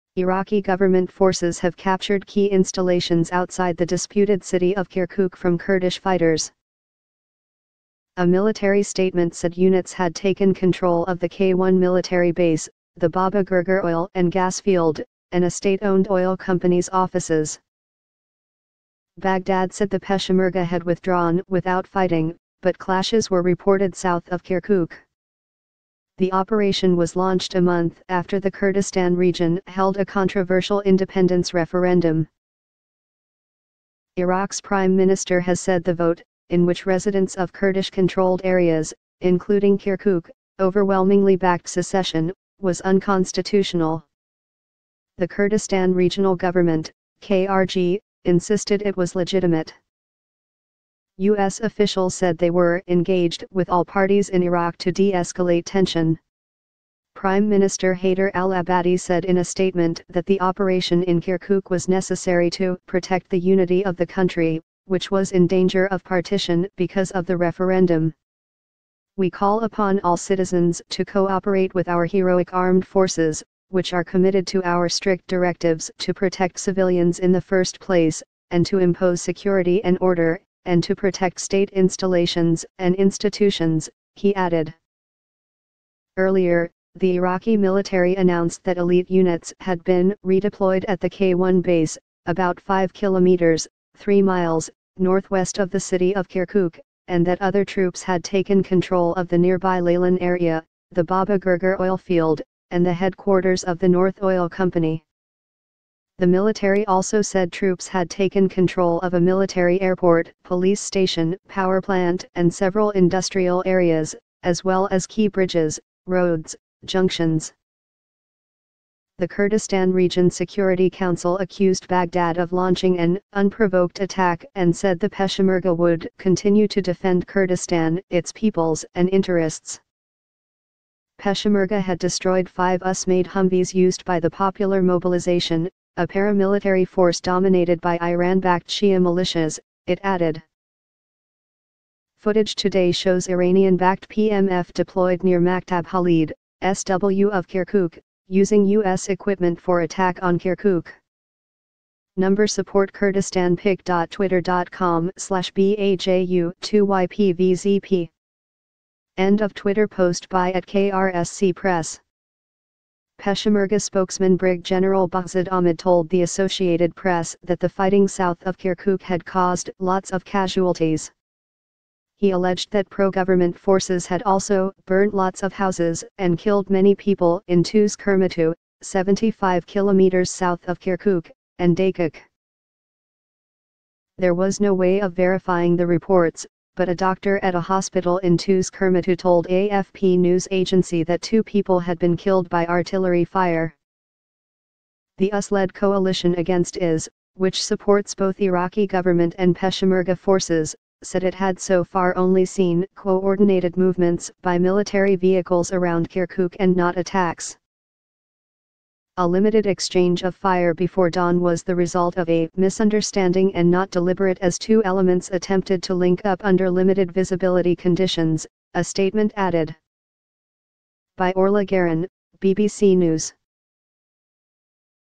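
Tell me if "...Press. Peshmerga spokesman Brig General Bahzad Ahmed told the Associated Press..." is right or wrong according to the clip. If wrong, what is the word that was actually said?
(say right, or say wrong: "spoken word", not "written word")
right.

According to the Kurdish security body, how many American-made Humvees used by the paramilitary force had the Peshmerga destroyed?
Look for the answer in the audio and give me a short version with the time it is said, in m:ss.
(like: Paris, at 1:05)
5, at 2:12.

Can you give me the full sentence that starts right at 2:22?
Footage today shows Iranian-backed PMF deployed near Maktab Khalid, SW of Kirkuk, using U.S.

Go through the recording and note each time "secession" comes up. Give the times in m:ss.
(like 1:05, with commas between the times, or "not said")
0:41.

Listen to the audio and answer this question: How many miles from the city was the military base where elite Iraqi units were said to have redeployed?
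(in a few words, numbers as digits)
3.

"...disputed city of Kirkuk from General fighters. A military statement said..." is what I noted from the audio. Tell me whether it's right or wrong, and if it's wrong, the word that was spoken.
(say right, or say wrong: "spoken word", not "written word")
wrong: "Kurdish", not "General".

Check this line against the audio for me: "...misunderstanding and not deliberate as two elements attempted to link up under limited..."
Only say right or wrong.
right.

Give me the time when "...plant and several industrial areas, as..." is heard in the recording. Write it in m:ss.
1:51.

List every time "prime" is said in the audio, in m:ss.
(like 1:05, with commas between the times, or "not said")
0:34, 0:57.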